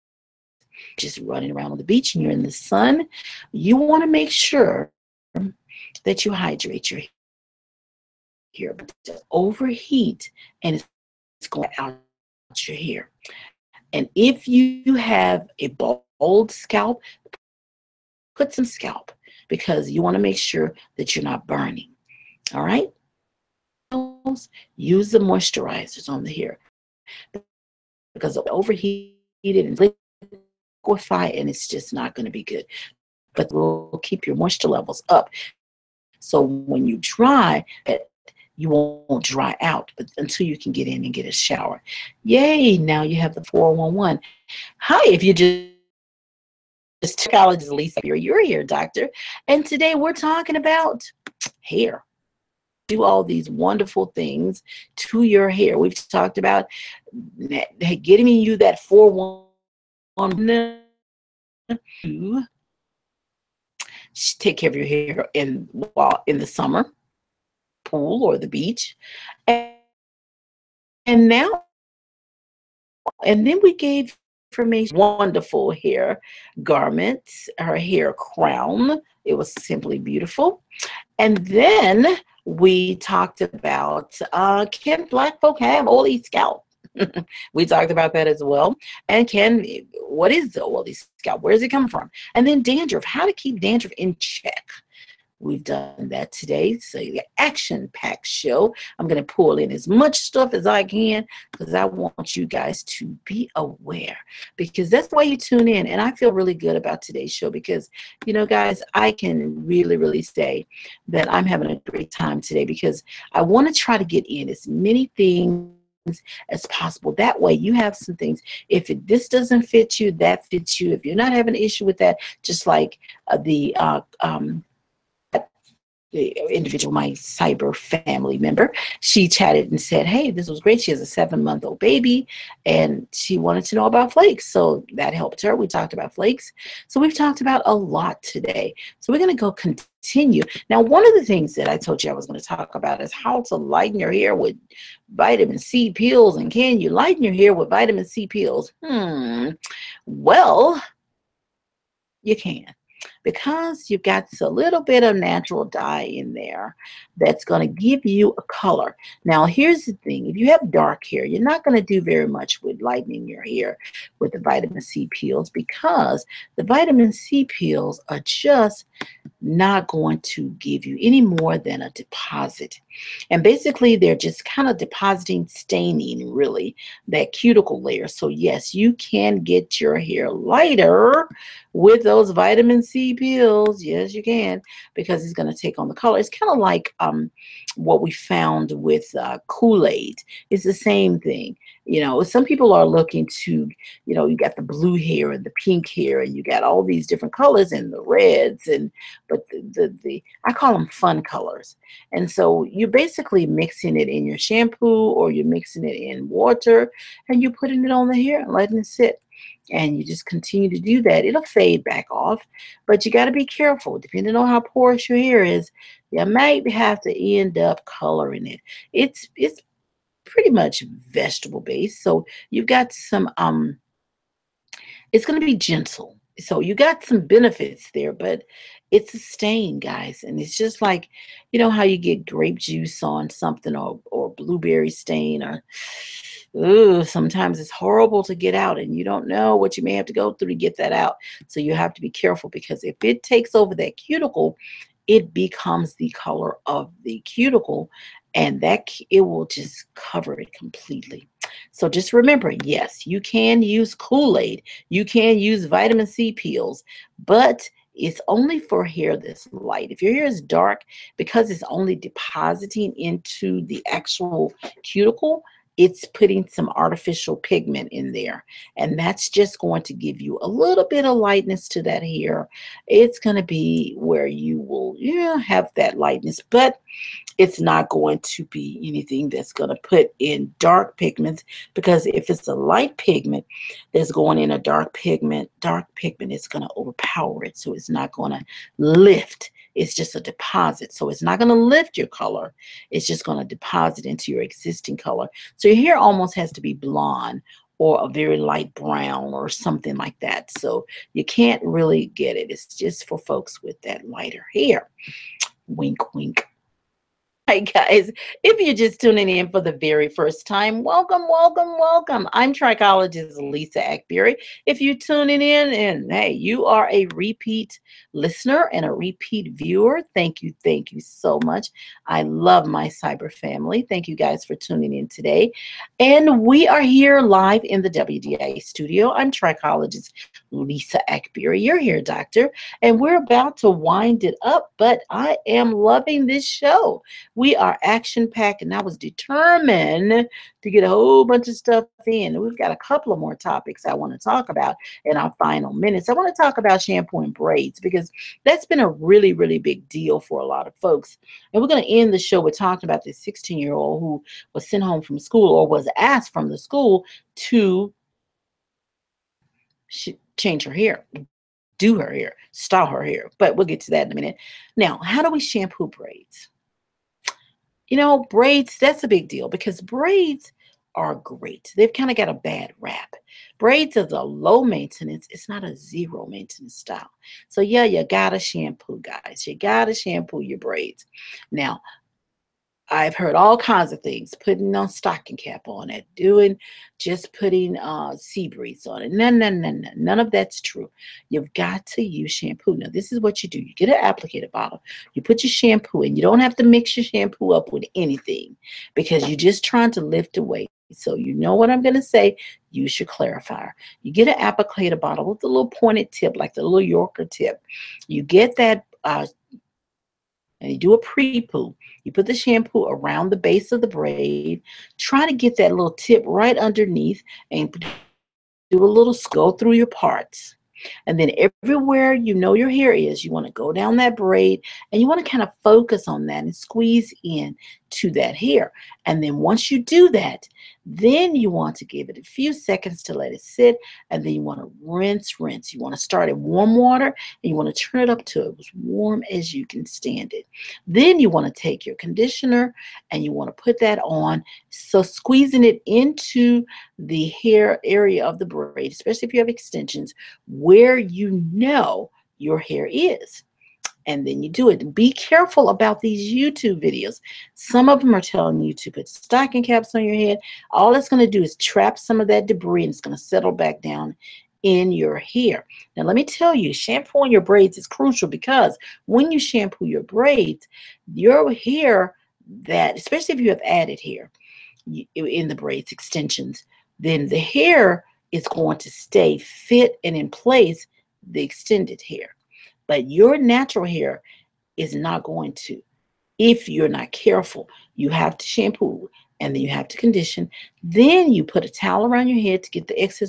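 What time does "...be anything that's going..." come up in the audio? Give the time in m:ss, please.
4:38.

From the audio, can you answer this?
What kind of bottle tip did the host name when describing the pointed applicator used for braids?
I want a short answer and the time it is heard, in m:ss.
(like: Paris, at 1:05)
Yorker tip, at 6:46.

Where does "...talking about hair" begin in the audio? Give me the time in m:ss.
0:50.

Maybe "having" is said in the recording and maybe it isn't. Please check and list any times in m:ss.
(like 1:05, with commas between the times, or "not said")
1:51, 2:01.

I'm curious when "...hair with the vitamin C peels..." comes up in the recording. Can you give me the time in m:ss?
2:43.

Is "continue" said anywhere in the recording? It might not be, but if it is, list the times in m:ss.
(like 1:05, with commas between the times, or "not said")
2:19, 3:30.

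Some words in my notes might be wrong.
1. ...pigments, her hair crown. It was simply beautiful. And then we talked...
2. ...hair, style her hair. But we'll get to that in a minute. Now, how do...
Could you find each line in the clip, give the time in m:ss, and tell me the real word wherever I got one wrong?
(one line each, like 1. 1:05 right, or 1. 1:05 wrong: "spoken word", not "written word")
1. 1:16 wrong: "garments", not "pigments"
2. 6:02 right.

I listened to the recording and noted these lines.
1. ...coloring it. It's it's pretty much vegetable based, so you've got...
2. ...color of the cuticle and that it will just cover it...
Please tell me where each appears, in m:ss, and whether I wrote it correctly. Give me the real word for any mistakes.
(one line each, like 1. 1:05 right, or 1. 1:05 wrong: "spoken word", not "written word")
1. 3:37 right
2. 4:06 right.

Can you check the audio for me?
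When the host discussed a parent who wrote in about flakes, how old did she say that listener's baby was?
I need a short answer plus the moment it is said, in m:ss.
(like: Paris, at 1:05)
7 months, at 2:11.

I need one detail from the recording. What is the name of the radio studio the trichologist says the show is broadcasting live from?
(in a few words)
WDIA.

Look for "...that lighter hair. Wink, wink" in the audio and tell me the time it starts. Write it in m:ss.
5:03.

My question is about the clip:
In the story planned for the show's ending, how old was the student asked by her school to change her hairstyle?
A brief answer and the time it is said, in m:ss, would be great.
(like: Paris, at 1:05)
16, at 5:53.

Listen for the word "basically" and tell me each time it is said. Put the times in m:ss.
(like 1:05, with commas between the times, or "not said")
2:53, 3:22.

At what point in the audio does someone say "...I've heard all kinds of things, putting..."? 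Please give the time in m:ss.
6:22.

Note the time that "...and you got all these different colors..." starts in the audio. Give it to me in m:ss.
3:16.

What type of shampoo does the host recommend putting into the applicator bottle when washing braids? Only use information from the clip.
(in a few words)
Clarifier.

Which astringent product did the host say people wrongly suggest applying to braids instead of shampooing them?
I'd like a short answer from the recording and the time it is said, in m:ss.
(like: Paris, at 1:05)
Sea Breeze, at 6:28.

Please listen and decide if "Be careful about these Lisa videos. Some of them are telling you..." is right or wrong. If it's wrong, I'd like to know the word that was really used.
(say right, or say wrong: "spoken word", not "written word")
wrong: "YouTube", not "Lisa".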